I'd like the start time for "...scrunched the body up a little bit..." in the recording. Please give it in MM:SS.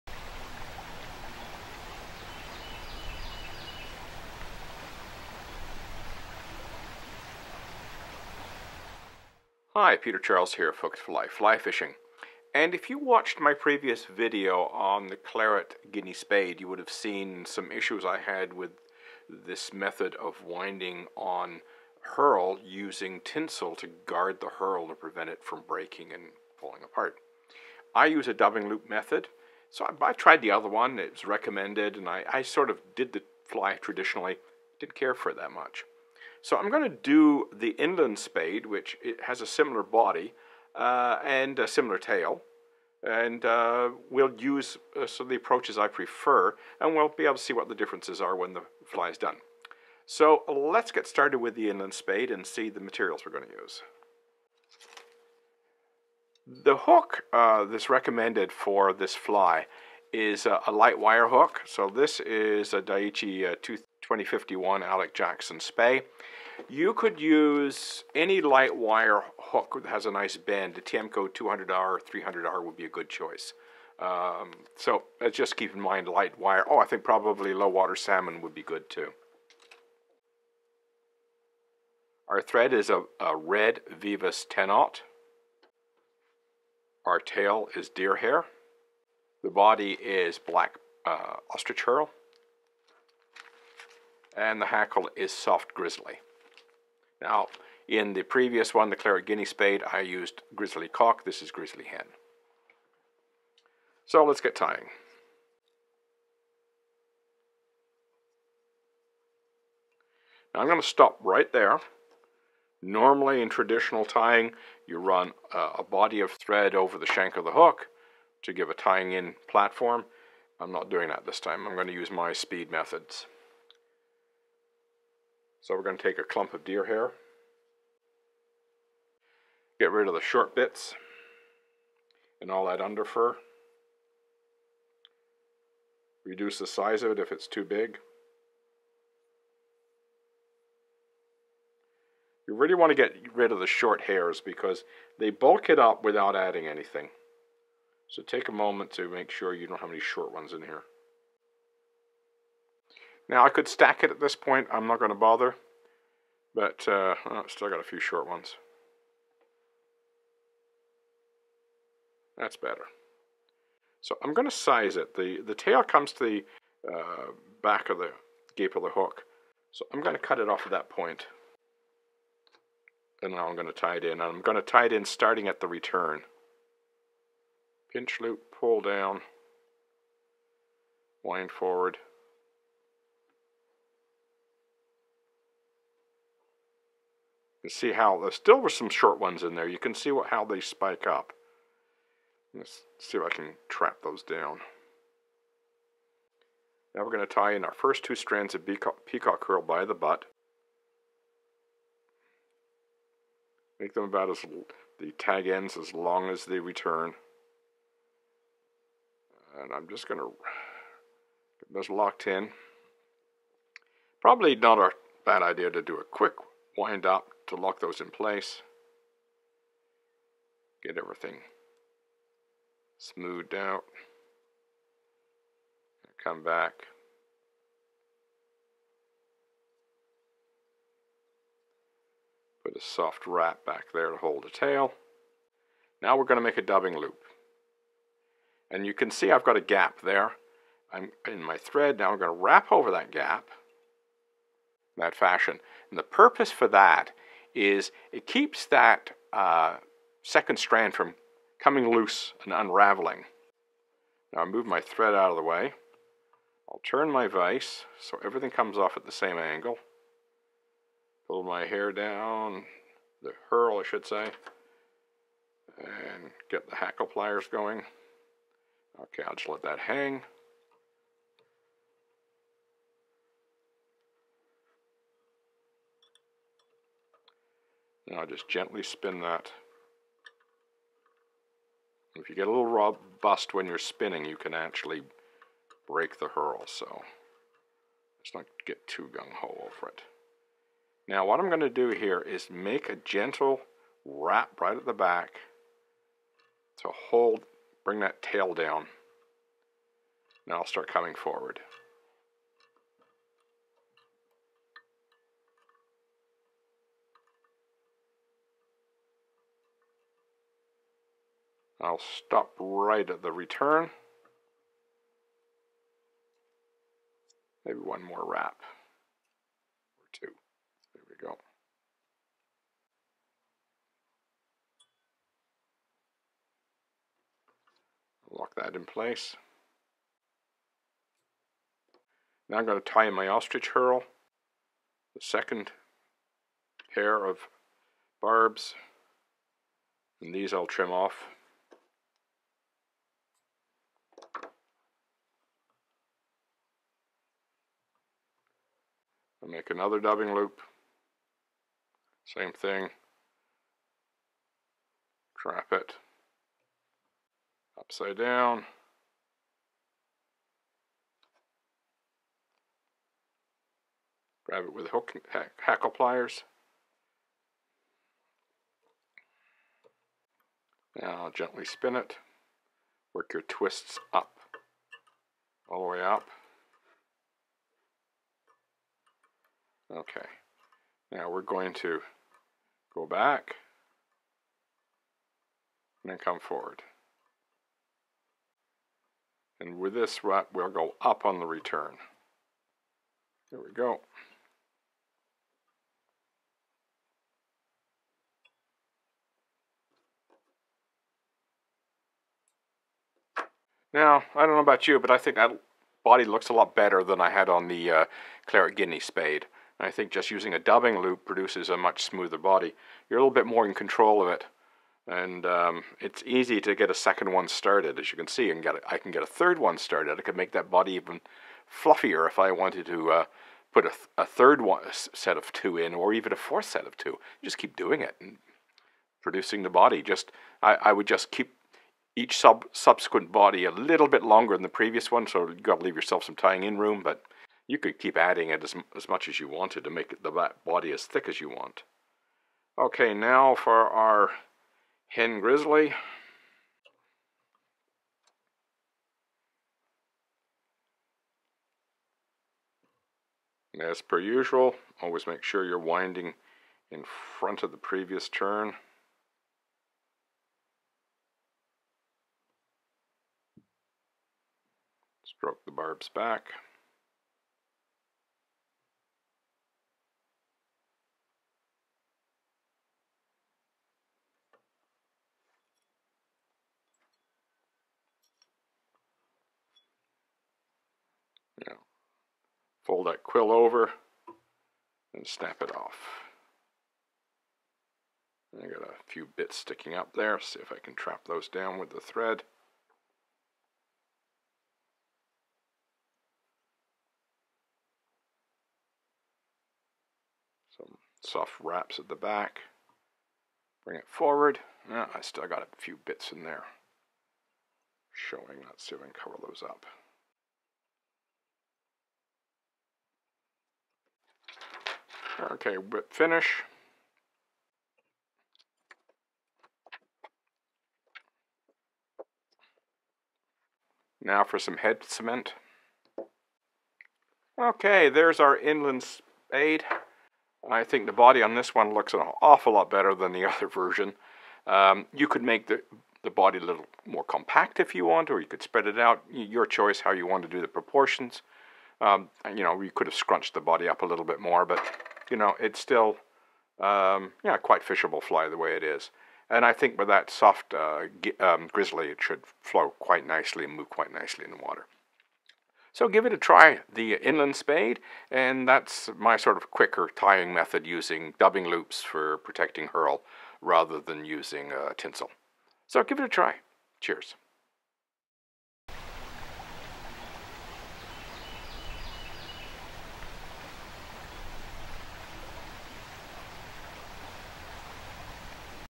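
09:03.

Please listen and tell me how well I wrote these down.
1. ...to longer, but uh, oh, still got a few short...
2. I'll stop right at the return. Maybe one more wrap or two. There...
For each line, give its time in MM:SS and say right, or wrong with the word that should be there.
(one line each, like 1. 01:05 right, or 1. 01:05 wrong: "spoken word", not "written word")
1. 02:35 wrong: "bother", not "longer"
2. 05:11 right.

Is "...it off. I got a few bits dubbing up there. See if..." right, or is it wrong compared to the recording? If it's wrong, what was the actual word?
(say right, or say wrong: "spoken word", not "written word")
wrong: "sticking", not "dubbing".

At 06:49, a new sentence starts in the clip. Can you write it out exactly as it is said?
I think just using a dubbing loop produces a much smoother body.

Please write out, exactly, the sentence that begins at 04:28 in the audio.
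Okay, I'll just let that hang.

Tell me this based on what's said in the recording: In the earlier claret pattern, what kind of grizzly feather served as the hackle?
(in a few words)
Grizzly cock.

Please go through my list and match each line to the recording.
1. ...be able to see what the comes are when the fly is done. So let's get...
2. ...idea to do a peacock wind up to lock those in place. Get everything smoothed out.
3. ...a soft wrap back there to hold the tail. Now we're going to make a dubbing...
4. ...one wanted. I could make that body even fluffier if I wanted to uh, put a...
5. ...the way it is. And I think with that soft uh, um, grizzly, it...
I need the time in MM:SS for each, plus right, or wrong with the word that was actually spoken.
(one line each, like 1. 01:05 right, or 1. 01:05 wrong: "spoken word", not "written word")
1. 00:47 wrong: "differences", not "comes"
2. 03:35 wrong: "quick", not "peacock"
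3. 03:52 right
4. 06:59 wrong: "started", not "wanted"
5. 09:08 right.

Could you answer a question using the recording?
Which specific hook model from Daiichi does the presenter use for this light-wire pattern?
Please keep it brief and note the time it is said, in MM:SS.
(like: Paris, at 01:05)
2051 Alec Jackson Spey, at 01:04.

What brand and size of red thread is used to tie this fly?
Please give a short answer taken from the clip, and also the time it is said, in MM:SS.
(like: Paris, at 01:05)
Veevus 10/0, at 01:23.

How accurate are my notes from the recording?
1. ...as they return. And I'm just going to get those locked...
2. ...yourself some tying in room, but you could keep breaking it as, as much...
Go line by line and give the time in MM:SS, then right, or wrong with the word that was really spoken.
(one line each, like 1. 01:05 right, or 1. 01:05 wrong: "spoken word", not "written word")
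1. 03:26 right
2. 07:15 wrong: "adding", not "breaking".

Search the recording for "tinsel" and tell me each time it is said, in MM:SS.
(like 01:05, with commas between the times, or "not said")
00:23, 09:24.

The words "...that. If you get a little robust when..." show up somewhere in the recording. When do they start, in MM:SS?
04:39.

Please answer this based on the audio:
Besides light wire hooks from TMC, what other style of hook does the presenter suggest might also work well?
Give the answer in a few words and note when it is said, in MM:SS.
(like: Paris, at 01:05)
Low water salmon, at 01:17.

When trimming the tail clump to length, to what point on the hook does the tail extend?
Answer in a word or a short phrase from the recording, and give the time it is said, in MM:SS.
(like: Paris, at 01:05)
Back of the gape, at 02:47.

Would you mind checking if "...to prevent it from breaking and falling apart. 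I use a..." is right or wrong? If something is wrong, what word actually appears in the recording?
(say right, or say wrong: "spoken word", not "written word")
right.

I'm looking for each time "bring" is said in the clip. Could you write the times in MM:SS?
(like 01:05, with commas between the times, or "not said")
04:57, 08:23.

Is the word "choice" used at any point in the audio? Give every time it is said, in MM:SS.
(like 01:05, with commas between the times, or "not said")
01:13, 08:59.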